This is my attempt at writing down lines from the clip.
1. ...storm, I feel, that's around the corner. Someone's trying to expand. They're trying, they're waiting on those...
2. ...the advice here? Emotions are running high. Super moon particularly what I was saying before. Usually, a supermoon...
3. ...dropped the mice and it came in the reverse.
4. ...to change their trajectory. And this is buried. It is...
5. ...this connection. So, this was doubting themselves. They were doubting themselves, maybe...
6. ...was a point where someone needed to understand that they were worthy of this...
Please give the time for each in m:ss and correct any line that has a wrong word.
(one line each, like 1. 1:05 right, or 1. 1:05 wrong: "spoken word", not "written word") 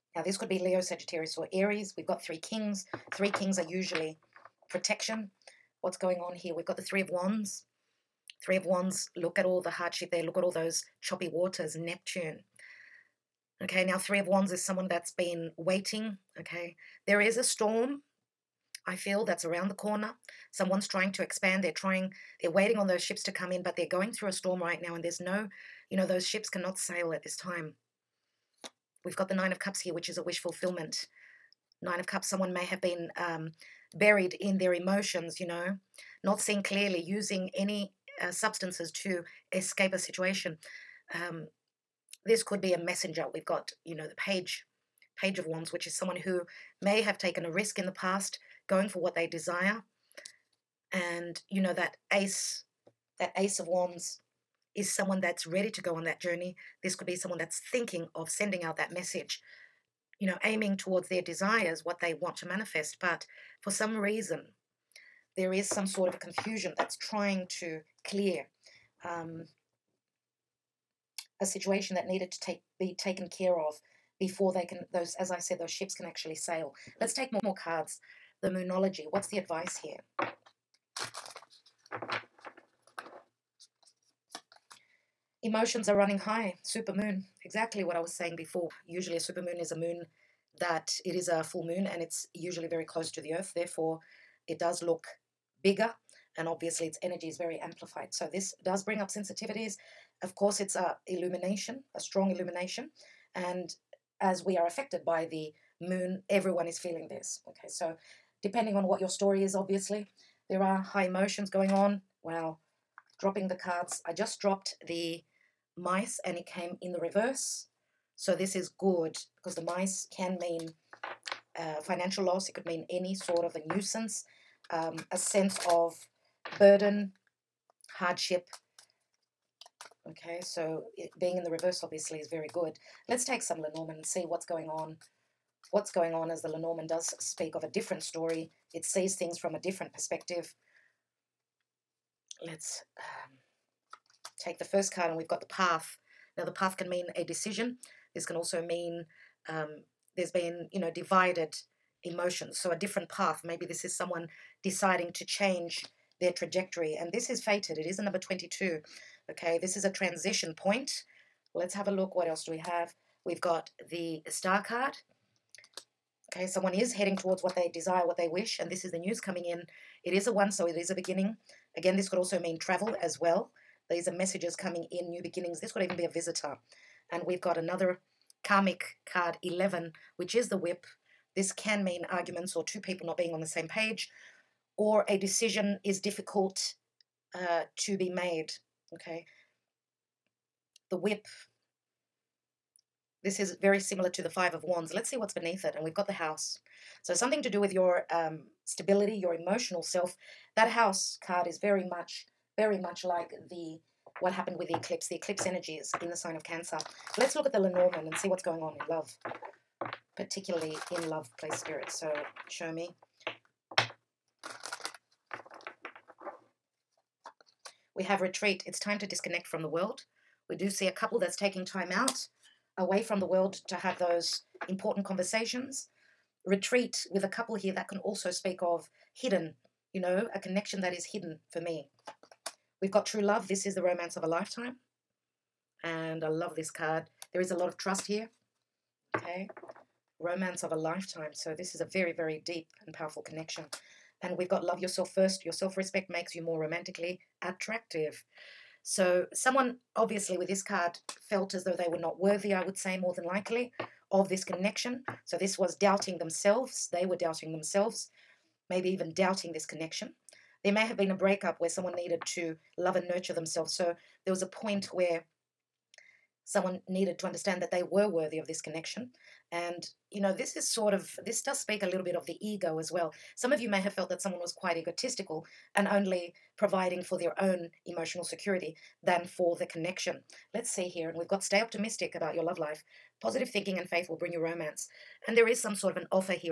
1. 0:17 right
2. 1:19 wrong: "exactly", not "particularly"
3. 1:54 right
4. 2:35 wrong: "fated", not "buried"
5. 4:14 right
6. 4:24 right.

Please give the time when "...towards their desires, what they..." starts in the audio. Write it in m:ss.
1:00.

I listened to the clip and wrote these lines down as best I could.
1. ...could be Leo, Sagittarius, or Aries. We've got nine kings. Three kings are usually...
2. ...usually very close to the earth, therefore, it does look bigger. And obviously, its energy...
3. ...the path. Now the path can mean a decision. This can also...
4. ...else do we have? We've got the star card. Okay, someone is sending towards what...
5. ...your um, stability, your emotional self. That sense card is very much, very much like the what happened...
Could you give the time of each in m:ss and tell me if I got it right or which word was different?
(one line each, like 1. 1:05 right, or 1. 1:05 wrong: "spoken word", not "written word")
1. 0:00 wrong: "three", not "nine"
2. 1:32 right
3. 2:25 right
4. 2:42 wrong: "heading", not "sending"
5. 3:17 wrong: "house", not "sense".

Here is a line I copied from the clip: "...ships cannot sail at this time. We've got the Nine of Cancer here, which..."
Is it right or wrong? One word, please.
wrong.